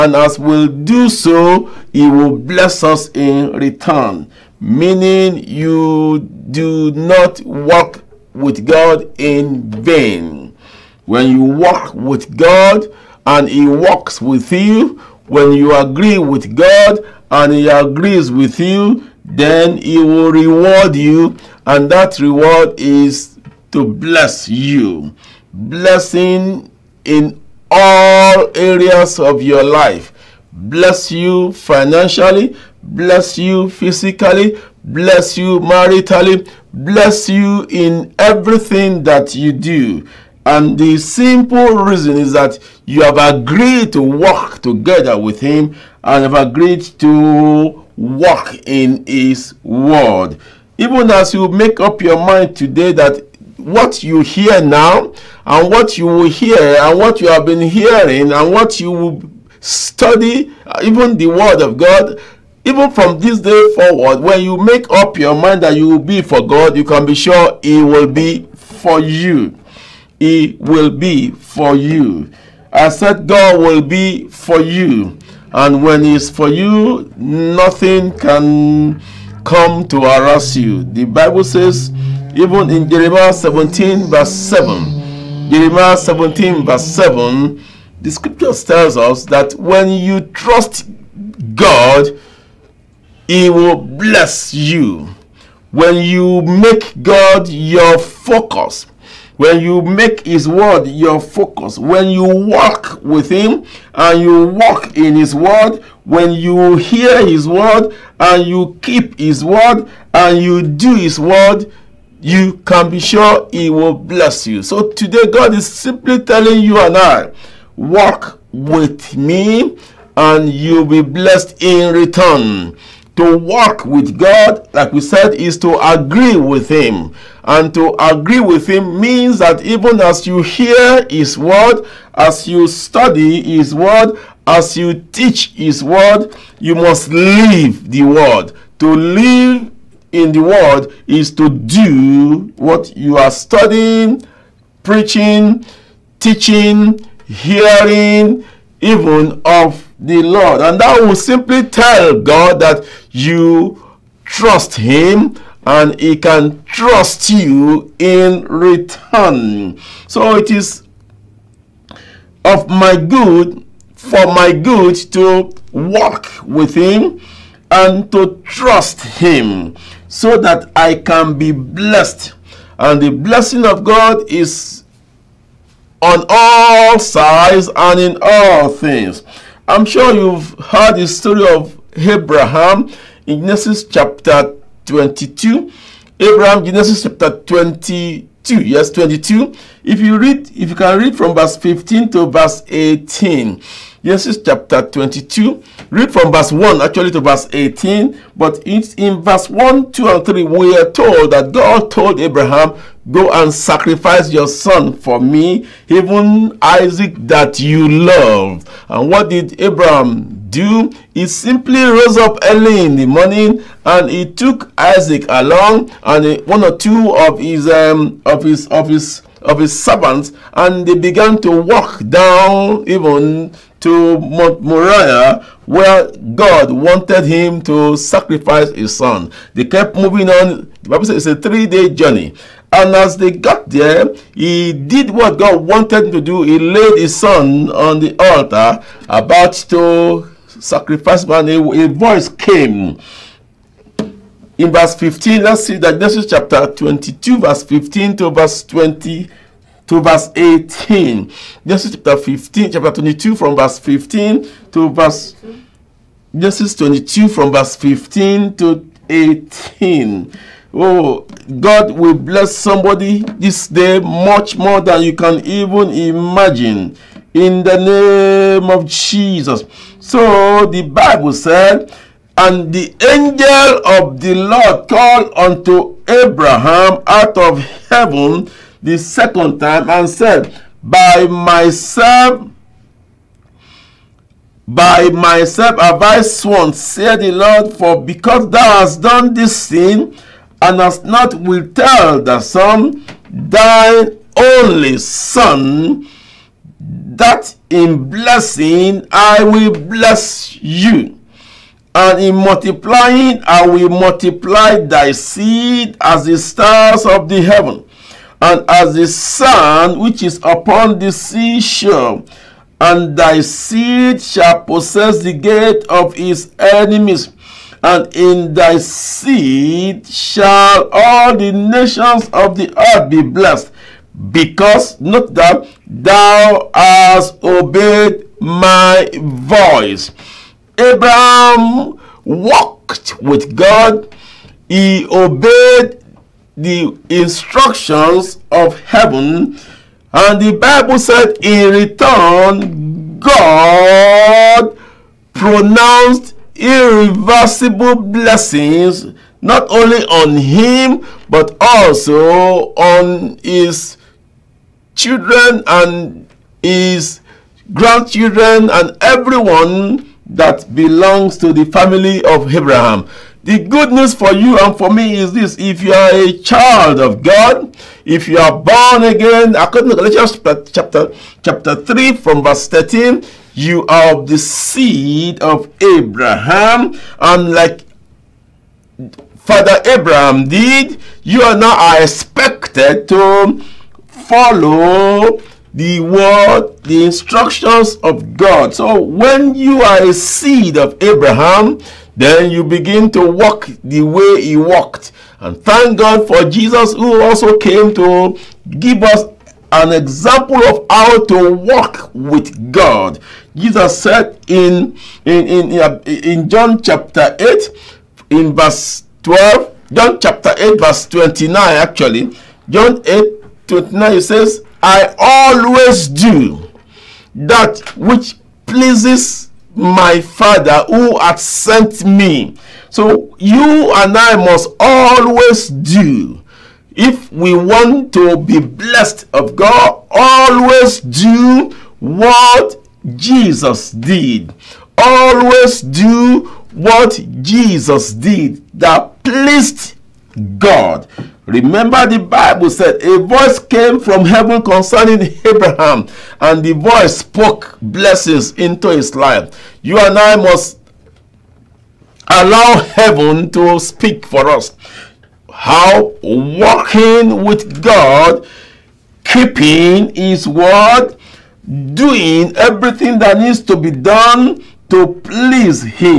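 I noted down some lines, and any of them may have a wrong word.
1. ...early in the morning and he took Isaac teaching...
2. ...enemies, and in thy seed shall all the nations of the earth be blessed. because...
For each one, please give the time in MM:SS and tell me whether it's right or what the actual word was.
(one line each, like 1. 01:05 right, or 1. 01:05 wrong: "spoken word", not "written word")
1. 03:32 wrong: "along", not "teaching"
2. 05:16 right.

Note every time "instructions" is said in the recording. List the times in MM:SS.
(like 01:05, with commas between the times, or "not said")
05:37, 06:27.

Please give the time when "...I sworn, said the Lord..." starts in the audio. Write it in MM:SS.
04:45.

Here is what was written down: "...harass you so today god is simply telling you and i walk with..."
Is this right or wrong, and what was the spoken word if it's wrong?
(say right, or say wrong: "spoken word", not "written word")
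wrong: "bless", not "harass".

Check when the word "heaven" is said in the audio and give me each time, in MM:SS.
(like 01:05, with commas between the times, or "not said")
04:37, 05:07, 05:38, 07:24, 07:32.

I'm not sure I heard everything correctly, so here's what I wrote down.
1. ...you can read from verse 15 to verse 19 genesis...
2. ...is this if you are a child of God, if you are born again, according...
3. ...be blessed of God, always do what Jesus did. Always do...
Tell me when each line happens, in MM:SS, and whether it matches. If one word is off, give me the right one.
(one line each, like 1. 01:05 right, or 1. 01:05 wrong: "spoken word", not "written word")
1. 03:10 wrong: "18", not "19"
2. 06:05 right
3. 07:08 right.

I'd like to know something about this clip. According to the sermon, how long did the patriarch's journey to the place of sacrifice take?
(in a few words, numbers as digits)
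3 days.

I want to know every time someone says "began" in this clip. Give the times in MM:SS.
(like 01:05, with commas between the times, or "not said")
03:40.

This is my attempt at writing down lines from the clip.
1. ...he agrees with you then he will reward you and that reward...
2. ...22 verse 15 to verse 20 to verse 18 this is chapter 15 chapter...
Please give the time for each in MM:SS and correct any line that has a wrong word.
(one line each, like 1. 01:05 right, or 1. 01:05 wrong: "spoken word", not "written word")
1. 00:17 right
2. 04:06 right.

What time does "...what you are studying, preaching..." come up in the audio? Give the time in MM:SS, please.
02:22.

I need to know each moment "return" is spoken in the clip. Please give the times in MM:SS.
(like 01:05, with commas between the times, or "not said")
00:03, 02:01, 02:38, 05:41.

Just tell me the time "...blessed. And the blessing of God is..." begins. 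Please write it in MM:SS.
02:51.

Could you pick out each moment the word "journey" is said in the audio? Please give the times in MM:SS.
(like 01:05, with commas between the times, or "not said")
03:51.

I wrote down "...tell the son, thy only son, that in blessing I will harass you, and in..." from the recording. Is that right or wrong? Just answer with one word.
wrong.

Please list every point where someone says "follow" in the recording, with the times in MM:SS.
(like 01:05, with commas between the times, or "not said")
06:24.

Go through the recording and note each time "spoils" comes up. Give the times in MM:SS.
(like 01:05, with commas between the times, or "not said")
not said.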